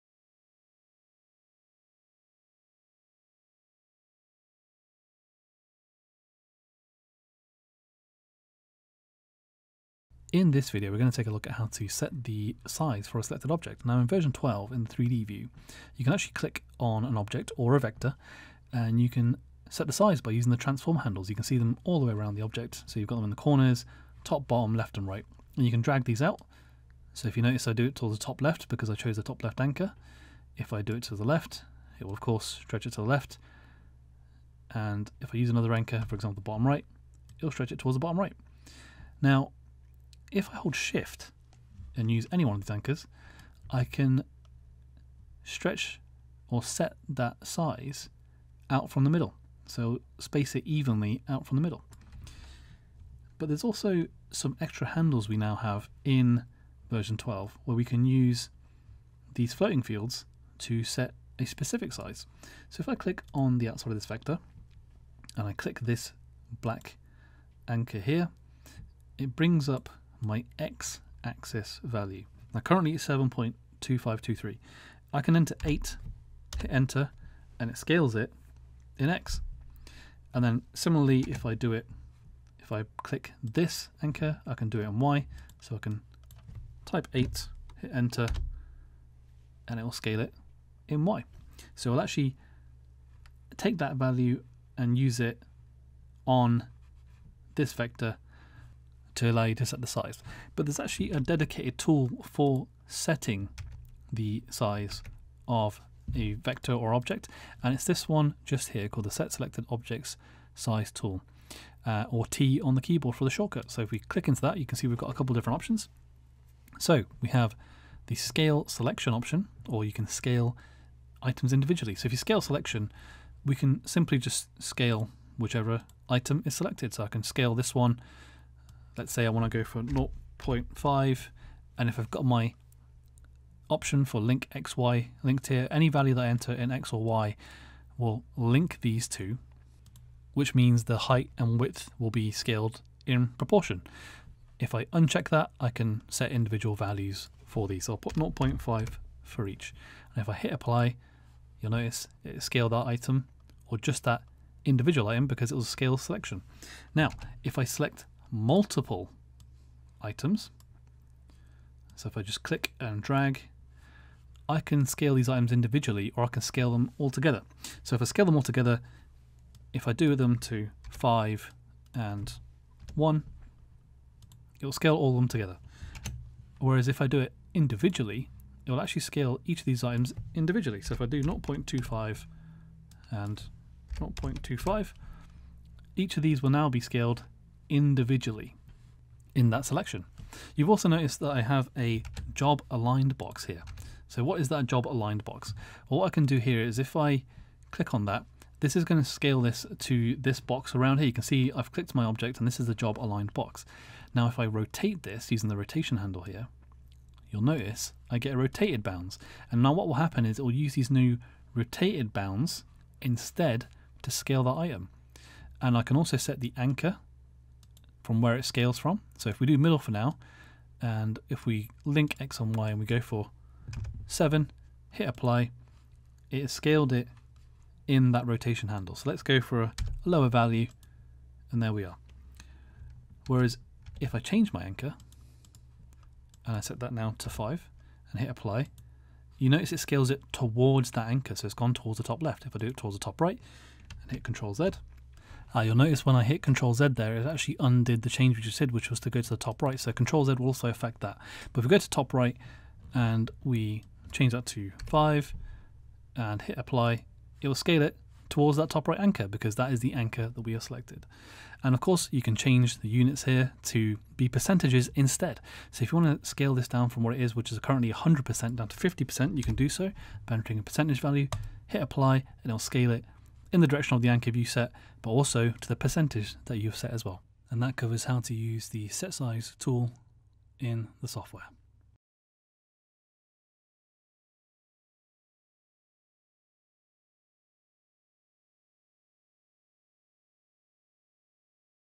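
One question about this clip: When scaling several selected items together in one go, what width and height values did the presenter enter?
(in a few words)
5 and 1.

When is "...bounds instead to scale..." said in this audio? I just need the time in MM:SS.
03:32.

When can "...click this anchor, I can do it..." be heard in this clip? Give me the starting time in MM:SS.
01:23.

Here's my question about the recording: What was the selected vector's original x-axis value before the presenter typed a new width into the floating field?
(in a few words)
7.2523.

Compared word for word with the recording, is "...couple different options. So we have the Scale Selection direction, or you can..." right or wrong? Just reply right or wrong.
wrong.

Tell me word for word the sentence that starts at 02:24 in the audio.
If I uncheck that, I can set individual values for these.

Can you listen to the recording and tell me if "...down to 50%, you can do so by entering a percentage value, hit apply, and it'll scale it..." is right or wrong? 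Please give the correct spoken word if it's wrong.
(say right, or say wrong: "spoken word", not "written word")
right.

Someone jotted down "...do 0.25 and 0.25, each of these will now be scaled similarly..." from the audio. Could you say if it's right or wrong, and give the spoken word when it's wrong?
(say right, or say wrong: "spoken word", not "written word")
wrong: "individually", not "similarly".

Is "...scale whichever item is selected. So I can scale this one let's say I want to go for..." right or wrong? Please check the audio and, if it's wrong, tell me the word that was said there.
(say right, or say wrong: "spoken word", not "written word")
right.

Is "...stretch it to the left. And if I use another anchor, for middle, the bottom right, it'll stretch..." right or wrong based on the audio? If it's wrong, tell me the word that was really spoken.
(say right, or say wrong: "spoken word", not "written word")
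wrong: "example", not "middle".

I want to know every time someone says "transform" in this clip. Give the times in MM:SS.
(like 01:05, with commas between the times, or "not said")
00:20.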